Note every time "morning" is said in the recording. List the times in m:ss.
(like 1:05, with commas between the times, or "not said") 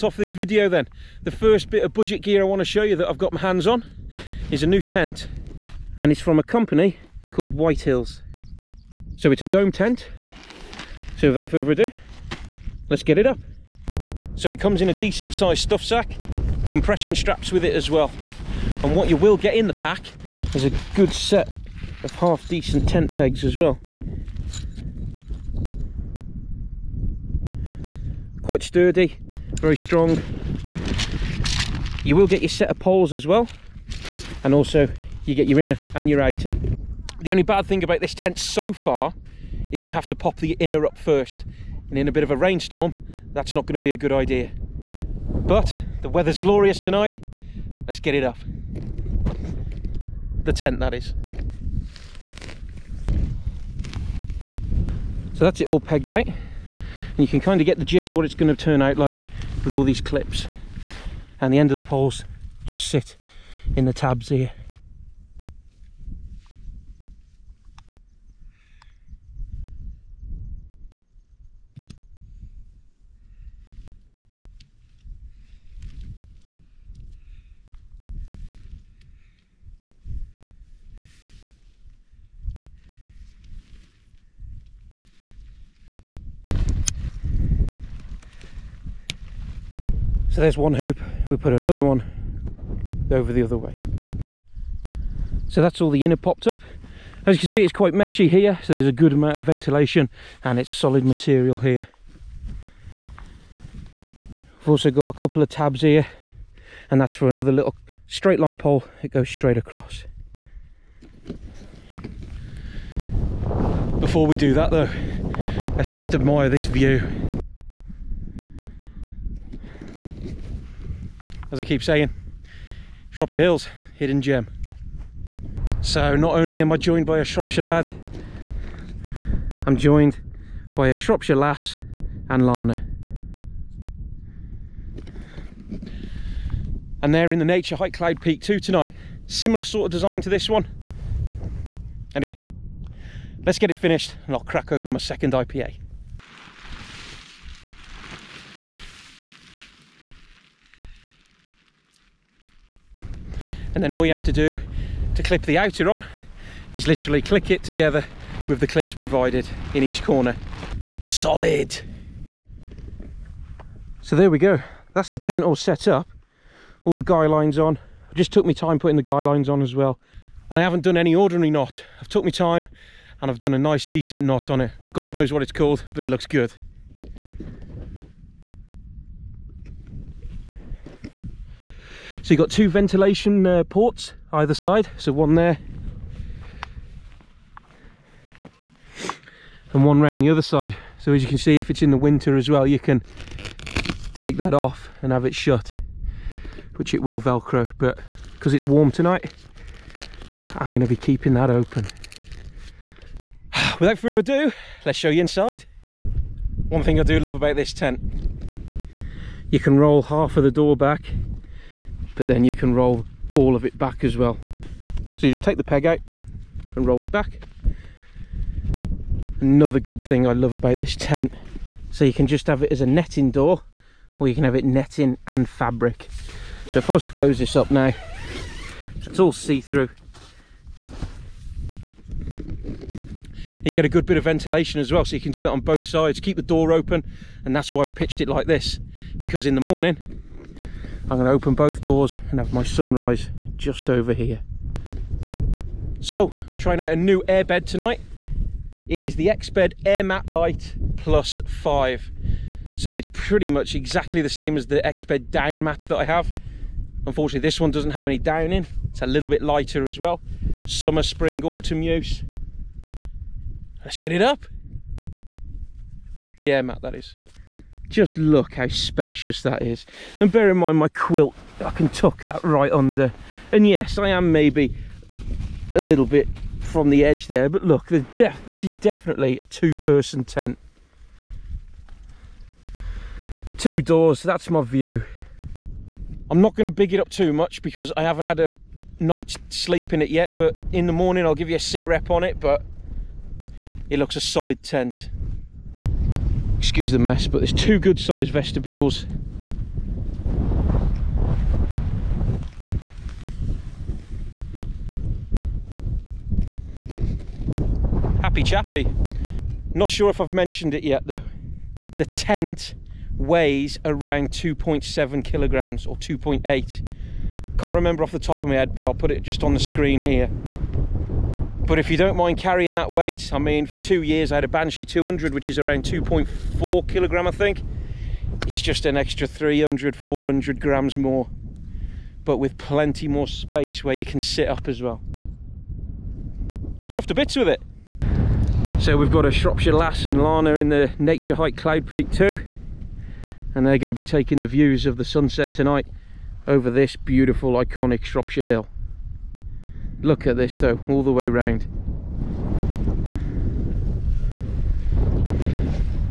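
3:59, 4:50.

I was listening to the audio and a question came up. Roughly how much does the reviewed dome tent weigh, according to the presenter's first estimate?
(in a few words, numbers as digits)
2.7 kilograms.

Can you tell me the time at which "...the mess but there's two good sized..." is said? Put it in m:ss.
4:56.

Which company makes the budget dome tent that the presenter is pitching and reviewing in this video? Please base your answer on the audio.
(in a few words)
Whitehills.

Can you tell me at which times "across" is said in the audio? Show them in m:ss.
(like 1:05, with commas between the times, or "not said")
1:49.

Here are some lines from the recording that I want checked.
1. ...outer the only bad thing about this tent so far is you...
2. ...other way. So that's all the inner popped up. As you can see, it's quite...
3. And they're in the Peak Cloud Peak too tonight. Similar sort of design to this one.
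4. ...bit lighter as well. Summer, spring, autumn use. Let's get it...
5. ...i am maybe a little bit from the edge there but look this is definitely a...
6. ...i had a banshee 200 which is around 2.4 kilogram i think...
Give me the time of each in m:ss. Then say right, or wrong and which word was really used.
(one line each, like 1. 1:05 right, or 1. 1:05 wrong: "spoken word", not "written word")
1. 0:36 right
2. 1:33 right
3. 2:17 wrong: "Naturehike", not "Peak"
4. 4:19 right
5. 4:33 right
6. 5:24 right.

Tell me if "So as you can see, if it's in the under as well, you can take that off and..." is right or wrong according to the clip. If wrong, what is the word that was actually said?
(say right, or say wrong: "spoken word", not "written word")
wrong: "winter", not "under".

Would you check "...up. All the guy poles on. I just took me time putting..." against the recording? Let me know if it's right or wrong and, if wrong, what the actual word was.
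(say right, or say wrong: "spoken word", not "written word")
wrong: "lines", not "poles".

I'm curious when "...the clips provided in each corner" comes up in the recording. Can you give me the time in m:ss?
2:38.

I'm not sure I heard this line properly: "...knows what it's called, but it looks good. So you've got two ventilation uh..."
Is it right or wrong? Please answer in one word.
right.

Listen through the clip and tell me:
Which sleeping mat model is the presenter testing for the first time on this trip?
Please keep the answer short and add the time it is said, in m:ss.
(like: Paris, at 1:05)
Exped Air Mat Light Plus 5, at 4:09.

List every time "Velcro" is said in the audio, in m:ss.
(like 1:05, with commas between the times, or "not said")
3:17.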